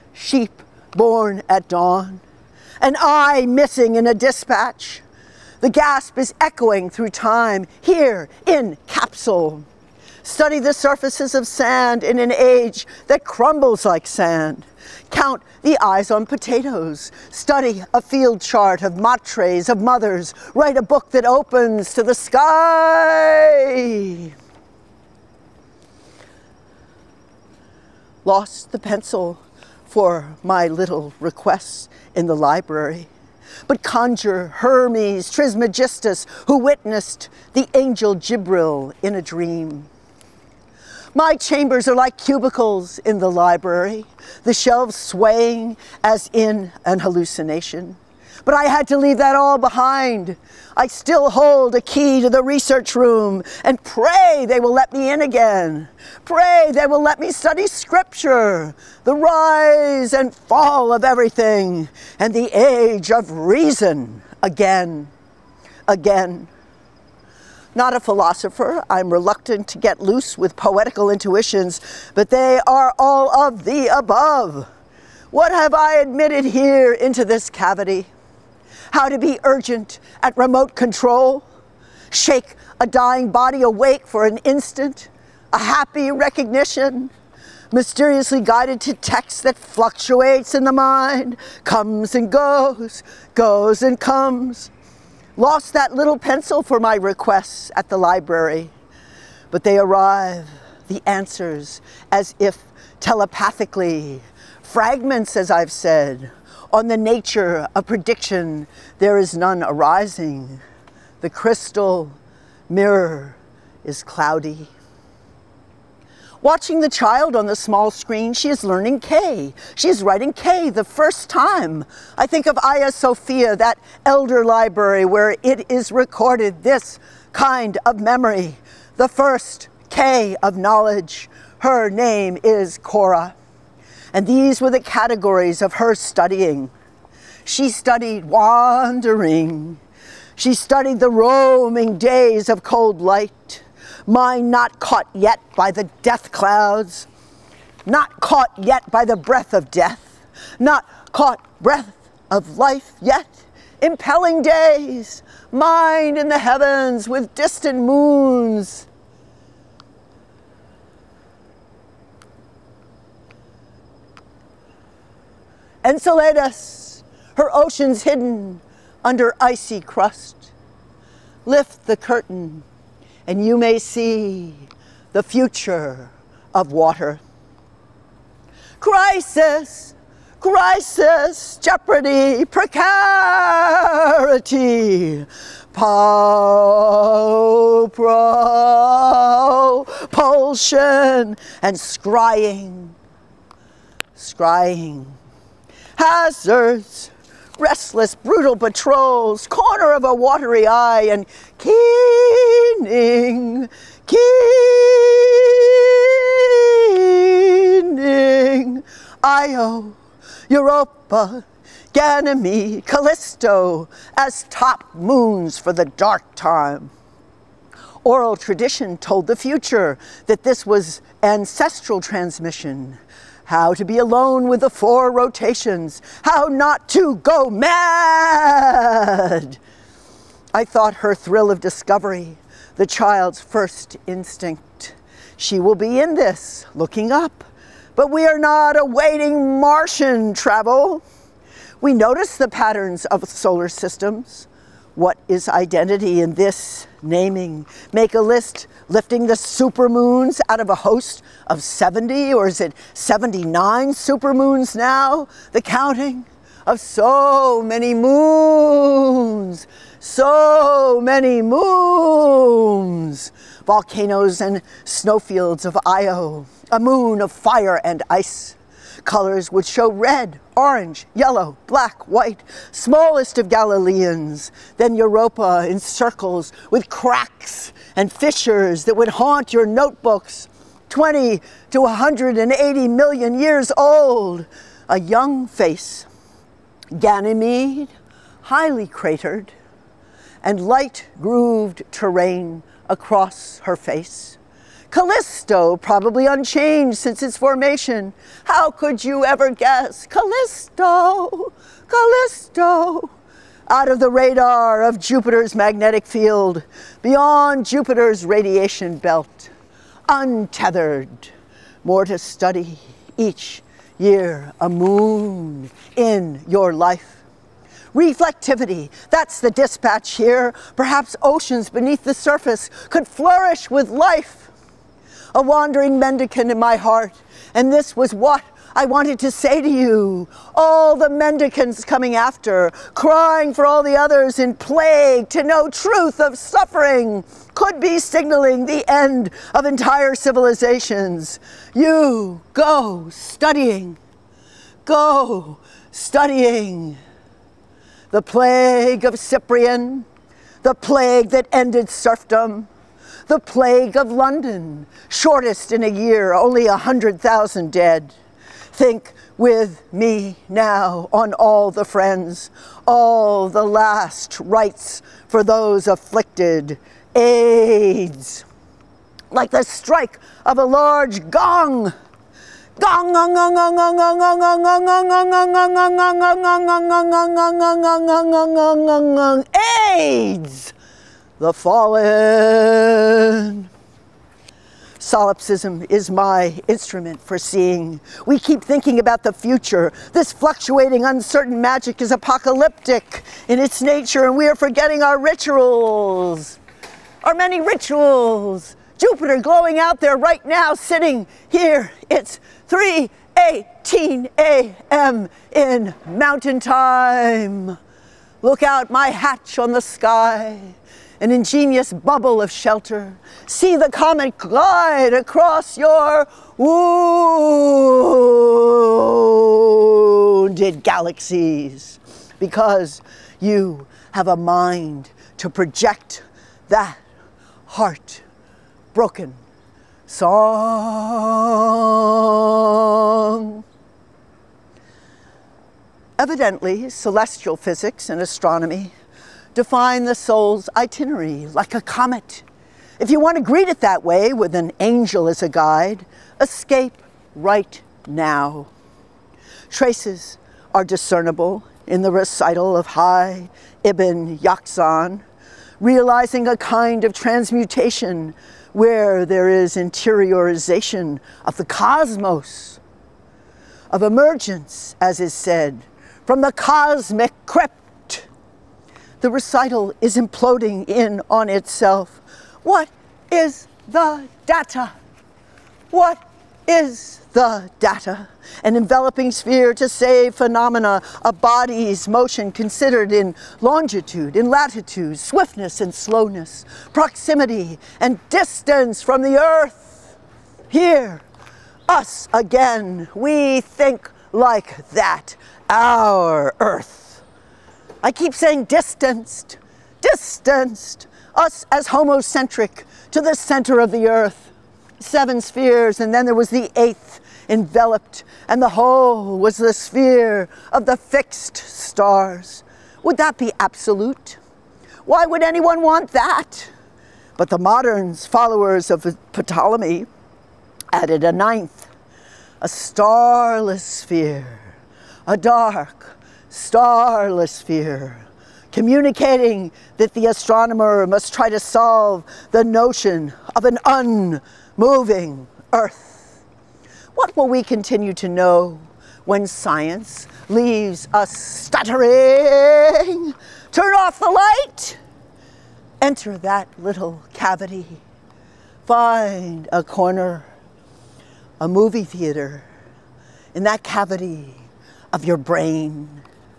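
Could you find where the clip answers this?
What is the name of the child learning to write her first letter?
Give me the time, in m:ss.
2:12.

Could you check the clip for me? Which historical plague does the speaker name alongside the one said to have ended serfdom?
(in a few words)
Plague of Cyprian.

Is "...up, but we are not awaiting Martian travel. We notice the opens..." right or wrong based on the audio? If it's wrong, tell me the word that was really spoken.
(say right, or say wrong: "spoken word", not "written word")
wrong: "patterns", not "opens".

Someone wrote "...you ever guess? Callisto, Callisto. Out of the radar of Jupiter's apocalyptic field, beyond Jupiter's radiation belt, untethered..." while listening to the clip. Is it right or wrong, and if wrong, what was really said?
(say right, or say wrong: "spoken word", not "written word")
wrong: "magnetic", not "apocalyptic".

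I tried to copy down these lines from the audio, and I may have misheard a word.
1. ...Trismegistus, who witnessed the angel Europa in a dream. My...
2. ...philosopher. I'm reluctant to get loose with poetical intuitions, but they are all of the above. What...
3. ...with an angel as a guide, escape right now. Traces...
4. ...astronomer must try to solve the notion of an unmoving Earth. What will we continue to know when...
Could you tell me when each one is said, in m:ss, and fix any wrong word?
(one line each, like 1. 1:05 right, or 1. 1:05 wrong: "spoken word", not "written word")
1. 0:35 wrong: "Gibril", not "Europa"
2. 1:08 right
3. 7:24 right
4. 8:50 right.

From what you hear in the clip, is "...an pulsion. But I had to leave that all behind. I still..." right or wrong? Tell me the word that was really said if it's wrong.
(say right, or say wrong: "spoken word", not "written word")
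wrong: "hallucination", not "pulsion".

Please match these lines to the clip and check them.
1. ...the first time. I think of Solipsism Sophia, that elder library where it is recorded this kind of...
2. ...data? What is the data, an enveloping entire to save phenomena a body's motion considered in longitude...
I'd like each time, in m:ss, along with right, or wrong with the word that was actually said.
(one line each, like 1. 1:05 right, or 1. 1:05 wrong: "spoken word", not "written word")
1. 2:00 wrong: "Aya", not "Solipsism"
2. 7:54 wrong: "sphere", not "entire".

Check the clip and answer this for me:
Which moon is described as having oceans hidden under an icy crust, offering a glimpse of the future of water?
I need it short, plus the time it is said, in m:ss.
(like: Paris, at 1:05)
Enceladus, at 2:45.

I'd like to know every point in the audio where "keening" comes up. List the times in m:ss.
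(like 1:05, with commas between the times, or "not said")
3:21, 3:27.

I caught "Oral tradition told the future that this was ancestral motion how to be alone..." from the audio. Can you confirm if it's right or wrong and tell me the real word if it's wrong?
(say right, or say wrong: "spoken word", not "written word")
wrong: "transmission", not "motion".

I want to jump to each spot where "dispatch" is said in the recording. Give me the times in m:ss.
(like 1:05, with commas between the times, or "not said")
0:04, 5:19.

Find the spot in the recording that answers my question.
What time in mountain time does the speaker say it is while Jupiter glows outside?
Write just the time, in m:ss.
6:42.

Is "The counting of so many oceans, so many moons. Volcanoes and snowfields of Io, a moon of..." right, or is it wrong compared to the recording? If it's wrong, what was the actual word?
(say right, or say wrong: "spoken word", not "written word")
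wrong: "moons", not "oceans".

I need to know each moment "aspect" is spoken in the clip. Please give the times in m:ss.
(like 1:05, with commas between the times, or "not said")
not said.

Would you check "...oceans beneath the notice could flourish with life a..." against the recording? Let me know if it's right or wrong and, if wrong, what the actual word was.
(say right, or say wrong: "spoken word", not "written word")
wrong: "surface", not "notice".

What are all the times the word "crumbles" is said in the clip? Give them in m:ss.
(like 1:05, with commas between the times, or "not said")
0:13.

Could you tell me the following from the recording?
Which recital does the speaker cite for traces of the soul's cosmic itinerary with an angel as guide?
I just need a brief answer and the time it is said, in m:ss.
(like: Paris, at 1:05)
Hai Ibn Yaqzan, at 7:32.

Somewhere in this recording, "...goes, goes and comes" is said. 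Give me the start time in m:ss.
1:32.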